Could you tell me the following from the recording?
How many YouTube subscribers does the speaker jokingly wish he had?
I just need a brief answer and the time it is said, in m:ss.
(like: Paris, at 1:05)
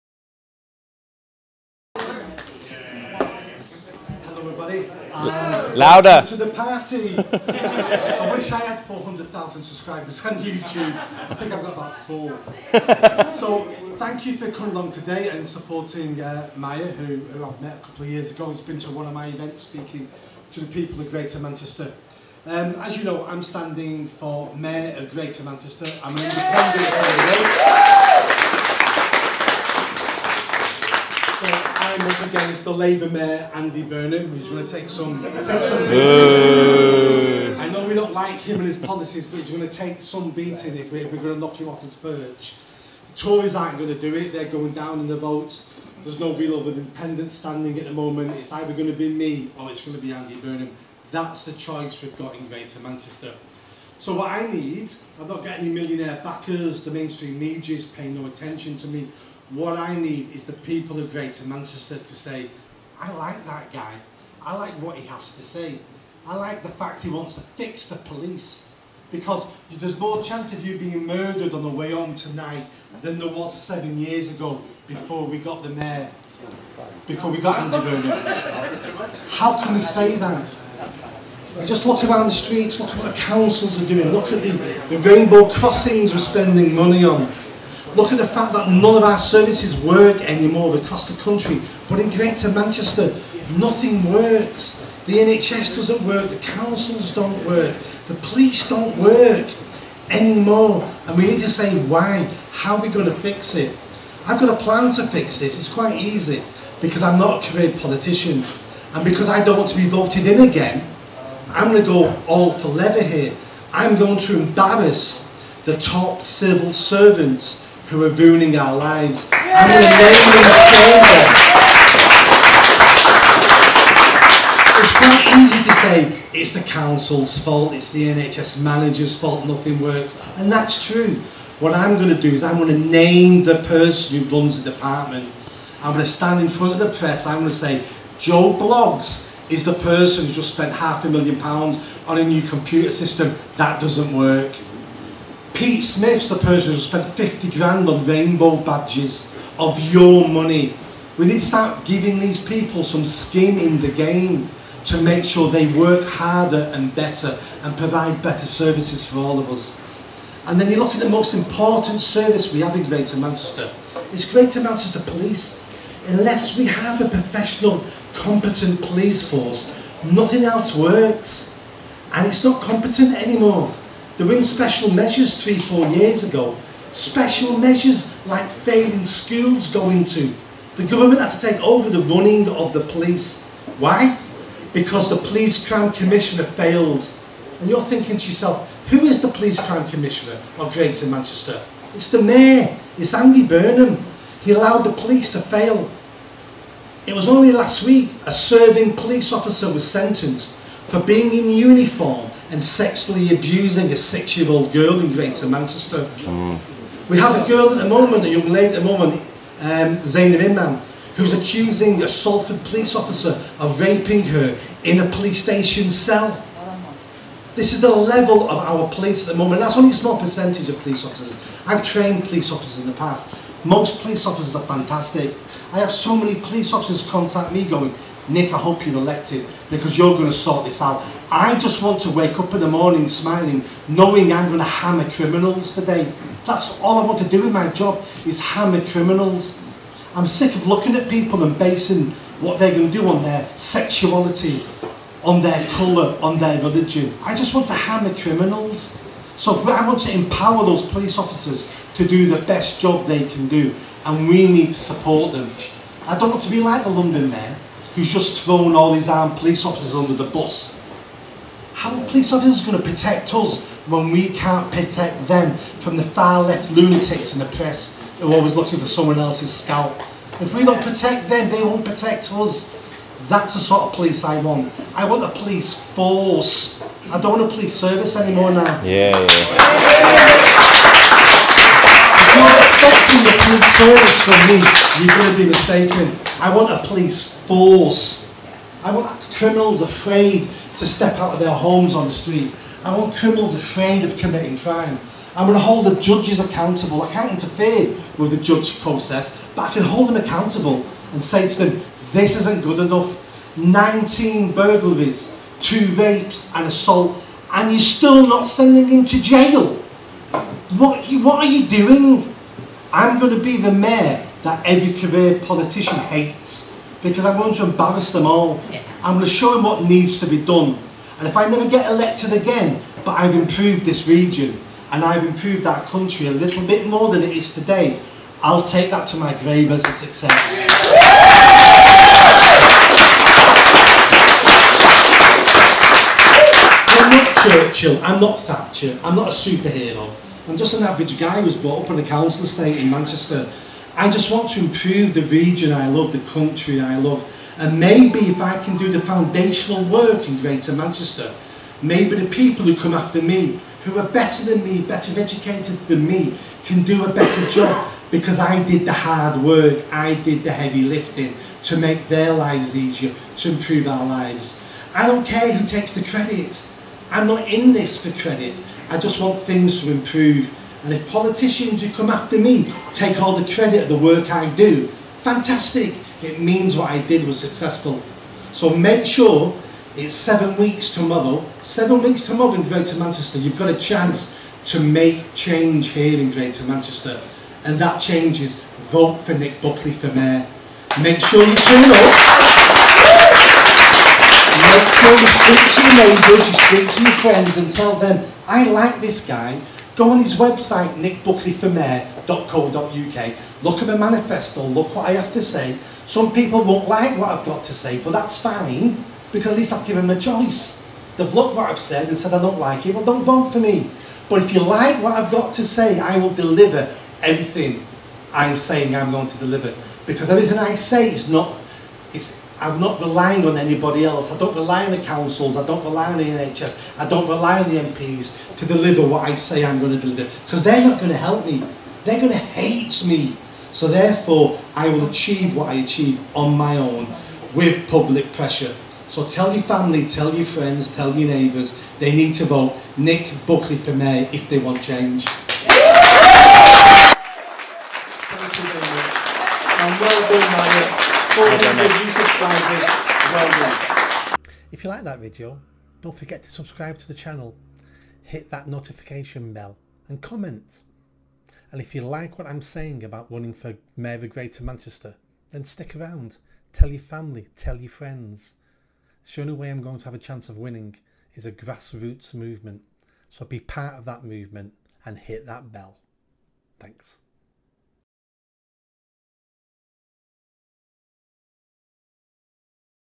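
400,000, at 0:08.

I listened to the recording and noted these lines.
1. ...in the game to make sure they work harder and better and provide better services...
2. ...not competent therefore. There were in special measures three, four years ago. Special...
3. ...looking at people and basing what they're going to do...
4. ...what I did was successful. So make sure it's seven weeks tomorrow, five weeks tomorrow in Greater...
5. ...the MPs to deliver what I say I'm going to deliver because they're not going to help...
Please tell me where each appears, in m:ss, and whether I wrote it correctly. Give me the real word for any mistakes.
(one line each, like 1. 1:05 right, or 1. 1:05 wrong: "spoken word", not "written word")
1. 2:33 right
2. 2:52 wrong: "anymore", not "therefore"
3. 4:00 right
4. 6:16 wrong: "seven", not "five"
5. 7:07 right.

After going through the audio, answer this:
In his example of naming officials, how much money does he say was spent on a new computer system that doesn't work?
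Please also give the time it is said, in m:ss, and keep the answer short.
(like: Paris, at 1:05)
half a million pounds, at 2:20.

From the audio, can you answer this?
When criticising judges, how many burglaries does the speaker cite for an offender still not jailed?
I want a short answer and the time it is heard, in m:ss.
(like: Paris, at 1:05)
19, at 5:03.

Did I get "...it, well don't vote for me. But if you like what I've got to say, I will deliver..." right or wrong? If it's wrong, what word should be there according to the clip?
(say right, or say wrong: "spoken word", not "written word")
right.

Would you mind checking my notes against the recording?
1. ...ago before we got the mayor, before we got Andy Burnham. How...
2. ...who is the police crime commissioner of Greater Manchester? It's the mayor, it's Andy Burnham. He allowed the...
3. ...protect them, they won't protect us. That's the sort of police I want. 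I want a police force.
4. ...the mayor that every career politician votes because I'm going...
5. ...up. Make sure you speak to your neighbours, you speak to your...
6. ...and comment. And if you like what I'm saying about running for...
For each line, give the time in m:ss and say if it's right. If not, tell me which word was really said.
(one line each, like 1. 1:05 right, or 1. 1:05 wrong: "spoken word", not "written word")
1. 1:14 right
2. 3:08 right
3. 4:30 right
4. 5:13 wrong: "hates", not "votes"
5. 6:31 right
6. 7:40 right.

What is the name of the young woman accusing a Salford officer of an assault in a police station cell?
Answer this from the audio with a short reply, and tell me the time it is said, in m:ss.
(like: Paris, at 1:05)
Zainab Imran, at 3:30.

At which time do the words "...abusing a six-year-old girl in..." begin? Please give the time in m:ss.
3:23.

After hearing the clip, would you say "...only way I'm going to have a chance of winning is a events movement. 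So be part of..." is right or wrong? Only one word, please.
wrong.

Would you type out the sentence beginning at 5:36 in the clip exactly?
I'm not Churchill, I'm not Thatcher, I'm not a superhero.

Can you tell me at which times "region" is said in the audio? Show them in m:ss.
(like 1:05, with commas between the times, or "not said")
5:24, 5:45.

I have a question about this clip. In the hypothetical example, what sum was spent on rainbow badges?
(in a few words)
50 grand.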